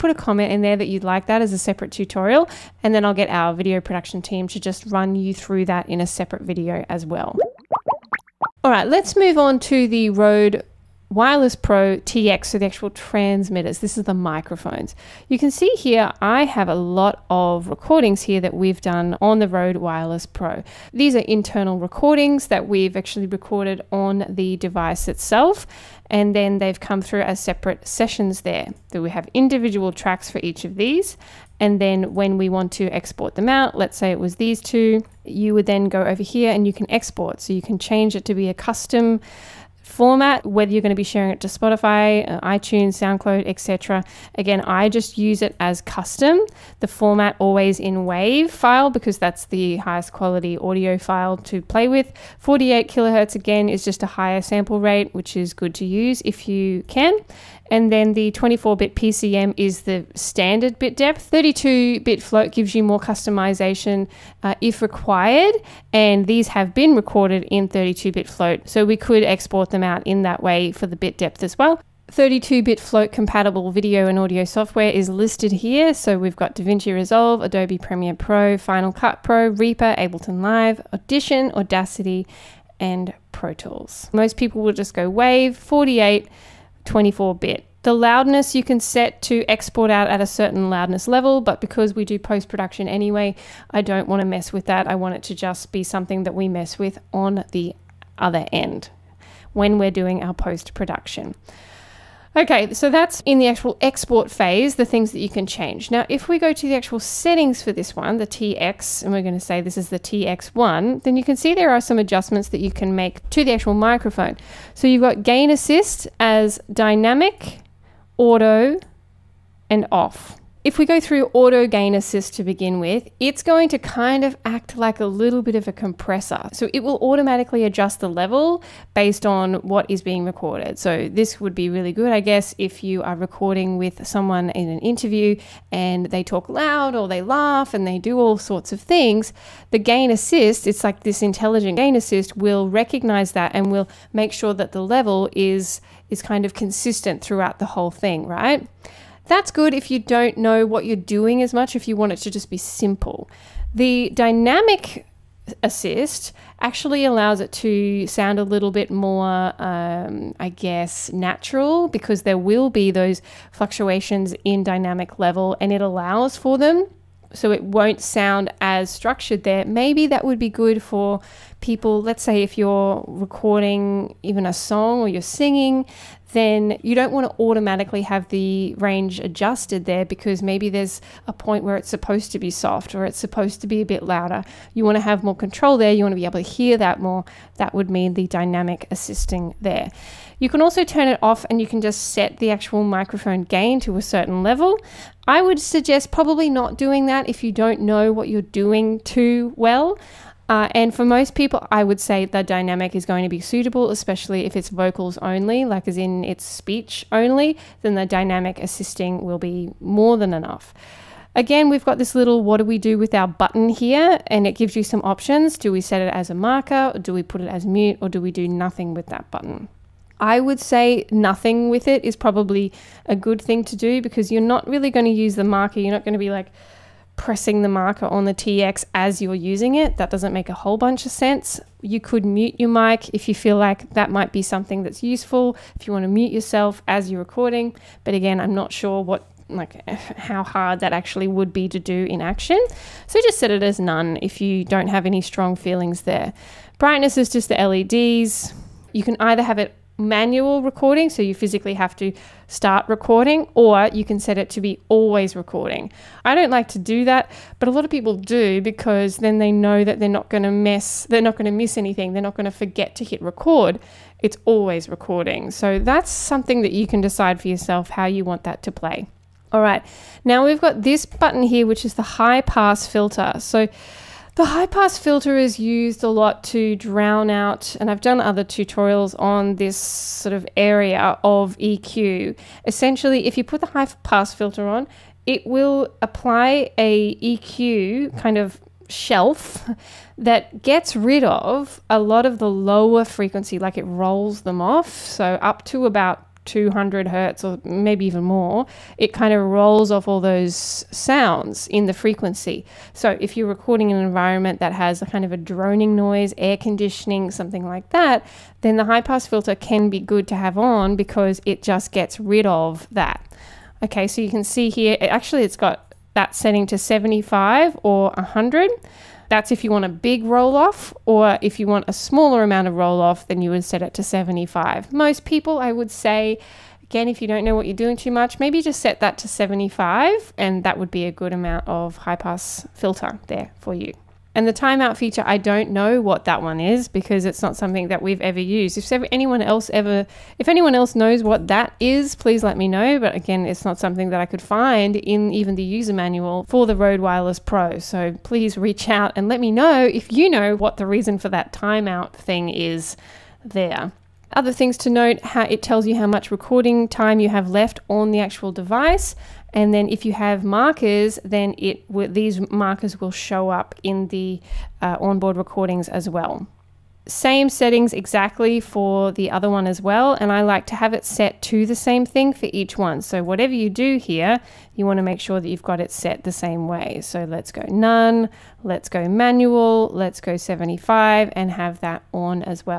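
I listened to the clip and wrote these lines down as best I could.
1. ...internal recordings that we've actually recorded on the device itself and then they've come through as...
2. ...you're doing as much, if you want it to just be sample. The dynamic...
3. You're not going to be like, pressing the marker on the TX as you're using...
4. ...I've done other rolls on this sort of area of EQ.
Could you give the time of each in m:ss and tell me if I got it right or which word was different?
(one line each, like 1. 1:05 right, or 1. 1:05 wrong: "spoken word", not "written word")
1. 0:21 right
2. 2:30 wrong: "simple", not "sample"
3. 3:45 right
4. 4:37 wrong: "tutorials", not "rolls".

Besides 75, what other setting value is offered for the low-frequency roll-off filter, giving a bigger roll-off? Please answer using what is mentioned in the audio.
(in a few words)
100.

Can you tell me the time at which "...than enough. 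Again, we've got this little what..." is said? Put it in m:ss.
3:30.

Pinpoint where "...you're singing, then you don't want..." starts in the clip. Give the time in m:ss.
2:55.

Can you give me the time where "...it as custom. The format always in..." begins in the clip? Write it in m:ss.
0:45.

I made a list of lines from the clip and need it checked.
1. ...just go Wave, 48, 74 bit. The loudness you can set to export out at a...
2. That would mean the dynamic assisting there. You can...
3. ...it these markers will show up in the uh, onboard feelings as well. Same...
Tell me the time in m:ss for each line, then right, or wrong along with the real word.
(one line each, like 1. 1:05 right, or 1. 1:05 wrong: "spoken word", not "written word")
1. 1:24 wrong: "24", not "74"
2. 3:07 right
3. 6:01 wrong: "recordings", not "feelings".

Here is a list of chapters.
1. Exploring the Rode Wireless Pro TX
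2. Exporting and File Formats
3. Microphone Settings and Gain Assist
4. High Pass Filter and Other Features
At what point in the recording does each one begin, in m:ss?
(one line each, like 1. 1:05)
1. 0:07
2. 0:30
3. 1:50
4. 4:29.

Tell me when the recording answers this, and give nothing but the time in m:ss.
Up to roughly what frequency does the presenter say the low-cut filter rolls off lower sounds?
4:56.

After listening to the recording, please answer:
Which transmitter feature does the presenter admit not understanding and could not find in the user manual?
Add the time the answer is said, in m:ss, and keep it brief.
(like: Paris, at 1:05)
Timeout feature, at 5:34.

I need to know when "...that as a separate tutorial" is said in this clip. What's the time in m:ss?
0:01.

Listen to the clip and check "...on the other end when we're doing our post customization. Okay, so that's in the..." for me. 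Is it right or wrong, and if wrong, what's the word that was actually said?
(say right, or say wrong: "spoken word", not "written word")
wrong: "production", not "customization".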